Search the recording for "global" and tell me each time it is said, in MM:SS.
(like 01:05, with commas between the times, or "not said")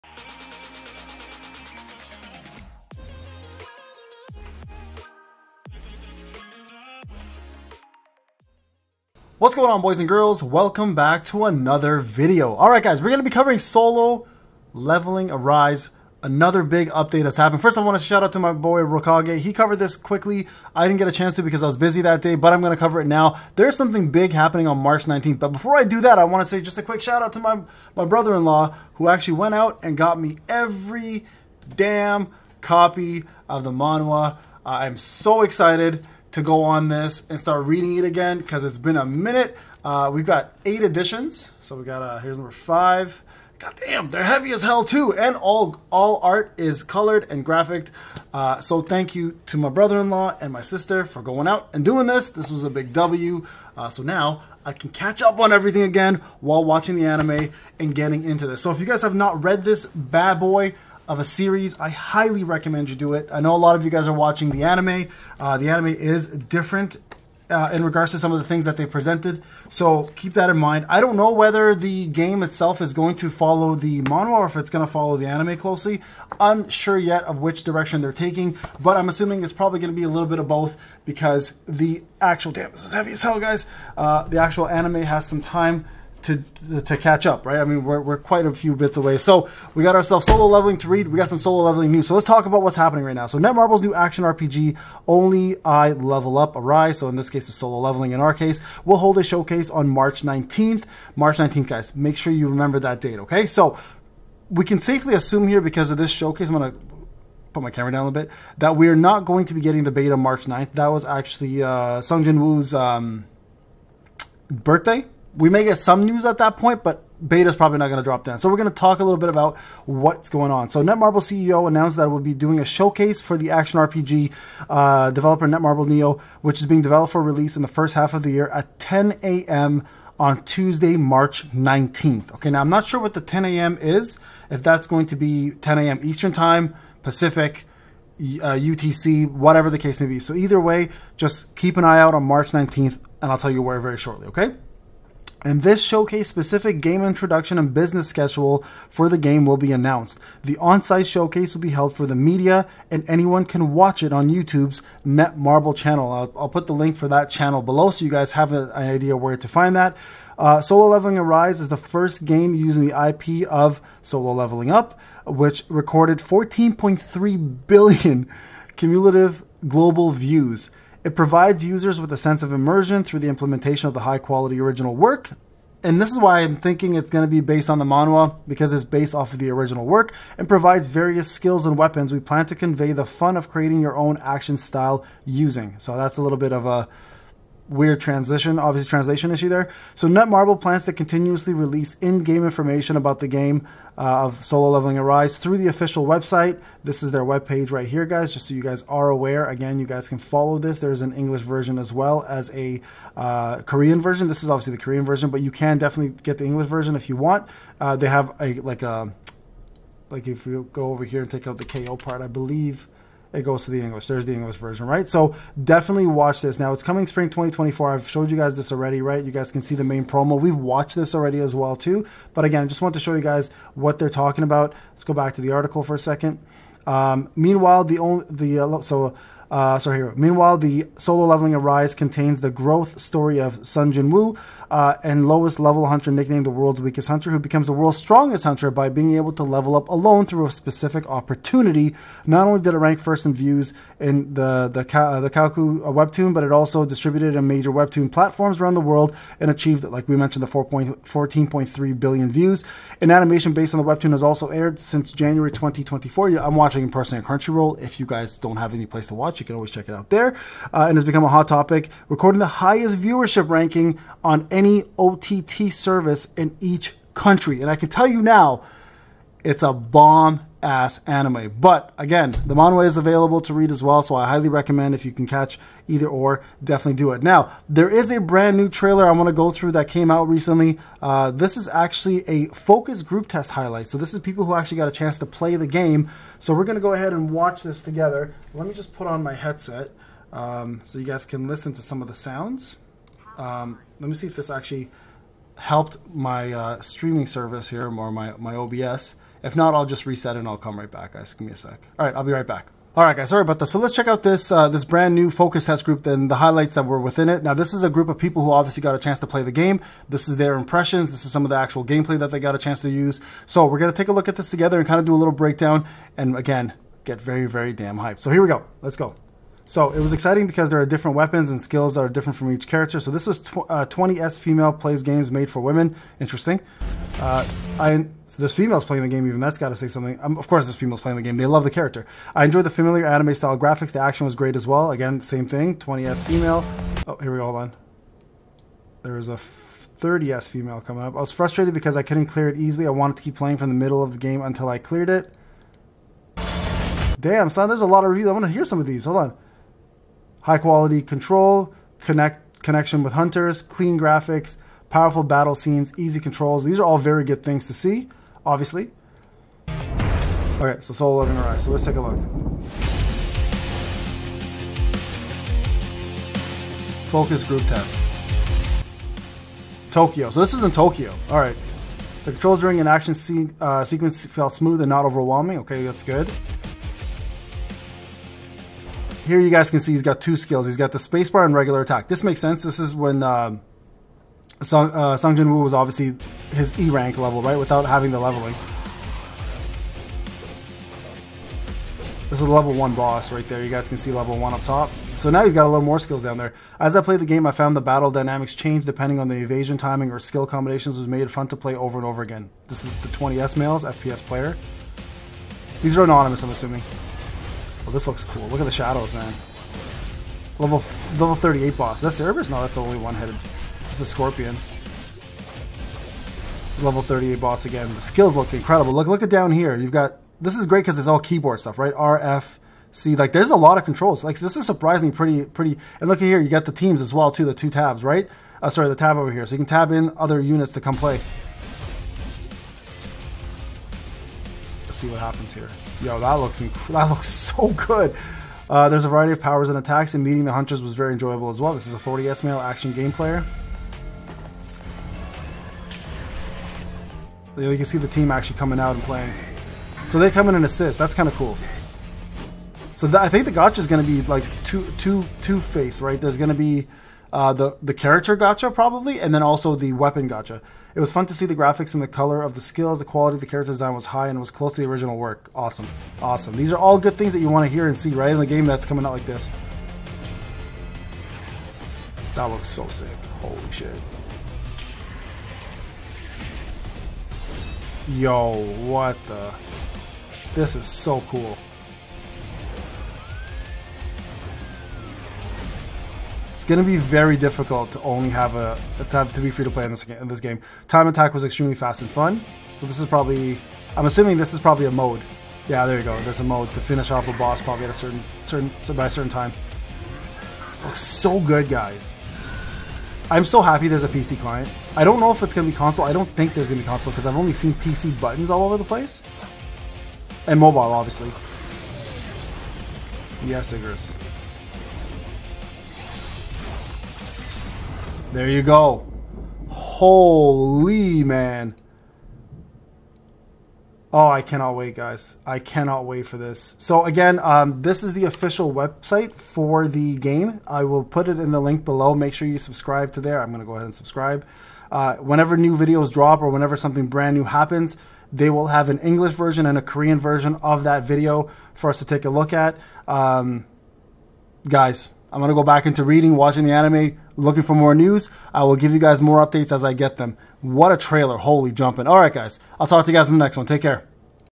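02:49.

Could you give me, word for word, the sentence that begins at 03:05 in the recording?
So that's a little bit of a weird transition, obviously translation issue there.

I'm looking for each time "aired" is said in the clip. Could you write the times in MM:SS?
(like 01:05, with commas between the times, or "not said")
04:14.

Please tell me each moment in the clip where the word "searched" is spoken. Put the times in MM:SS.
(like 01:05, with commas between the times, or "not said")
not said.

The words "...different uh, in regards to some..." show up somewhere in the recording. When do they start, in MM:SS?
01:06.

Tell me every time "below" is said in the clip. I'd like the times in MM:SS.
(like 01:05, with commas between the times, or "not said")
02:37, 08:51.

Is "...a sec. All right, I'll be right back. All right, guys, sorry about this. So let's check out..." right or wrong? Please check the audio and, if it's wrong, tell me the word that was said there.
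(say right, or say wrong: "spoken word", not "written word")
right.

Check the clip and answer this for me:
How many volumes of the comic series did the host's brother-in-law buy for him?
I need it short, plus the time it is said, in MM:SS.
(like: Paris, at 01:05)
8, at 00:40.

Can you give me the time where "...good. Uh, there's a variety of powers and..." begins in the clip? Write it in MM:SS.
07:17.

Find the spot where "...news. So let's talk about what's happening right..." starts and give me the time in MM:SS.
01:31.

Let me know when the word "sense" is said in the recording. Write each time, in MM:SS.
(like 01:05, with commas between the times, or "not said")
02:52, 06:22.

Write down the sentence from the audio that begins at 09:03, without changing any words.
Um, guys, I'm going to go back into reading, watching the anime, looking for more news.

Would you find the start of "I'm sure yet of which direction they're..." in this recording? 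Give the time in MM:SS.
01:16.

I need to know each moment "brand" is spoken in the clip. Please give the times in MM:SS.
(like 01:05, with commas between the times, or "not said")
04:38, 05:04, 08:57.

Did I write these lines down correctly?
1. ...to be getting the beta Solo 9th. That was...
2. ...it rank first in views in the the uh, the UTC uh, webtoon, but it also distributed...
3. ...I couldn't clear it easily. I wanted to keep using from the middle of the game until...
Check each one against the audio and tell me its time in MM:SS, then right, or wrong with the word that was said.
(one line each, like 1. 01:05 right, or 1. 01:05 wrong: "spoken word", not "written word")
1. 01:49 wrong: "March", not "Solo"
2. 04:02 wrong: "Kakao", not "UTC"
3. 05:41 wrong: "playing", not "using".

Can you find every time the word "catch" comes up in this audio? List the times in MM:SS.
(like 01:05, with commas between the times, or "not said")
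00:54, 01:26, 04:35.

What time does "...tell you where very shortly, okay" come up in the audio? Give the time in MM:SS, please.
02:23.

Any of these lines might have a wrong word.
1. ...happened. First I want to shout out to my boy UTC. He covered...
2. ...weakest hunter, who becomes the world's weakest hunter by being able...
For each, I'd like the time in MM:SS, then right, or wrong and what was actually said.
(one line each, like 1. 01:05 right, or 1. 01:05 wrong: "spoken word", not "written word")
1. 00:17 wrong: "Rokage", not "UTC"
2. 03:56 wrong: "strongest", not "weakest".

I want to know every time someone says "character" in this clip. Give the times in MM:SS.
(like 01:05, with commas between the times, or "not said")
05:22, 05:31, 07:37, 07:43.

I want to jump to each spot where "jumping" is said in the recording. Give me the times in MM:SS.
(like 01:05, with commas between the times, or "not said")
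09:11.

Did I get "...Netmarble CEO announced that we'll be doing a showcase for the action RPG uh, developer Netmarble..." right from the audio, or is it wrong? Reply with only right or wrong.
right.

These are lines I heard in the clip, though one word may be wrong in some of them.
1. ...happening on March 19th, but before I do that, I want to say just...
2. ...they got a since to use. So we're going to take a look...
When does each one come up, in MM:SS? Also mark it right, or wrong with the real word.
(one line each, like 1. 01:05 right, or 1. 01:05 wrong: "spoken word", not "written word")
1. 00:24 right
2. 05:12 wrong: "chance", not "since".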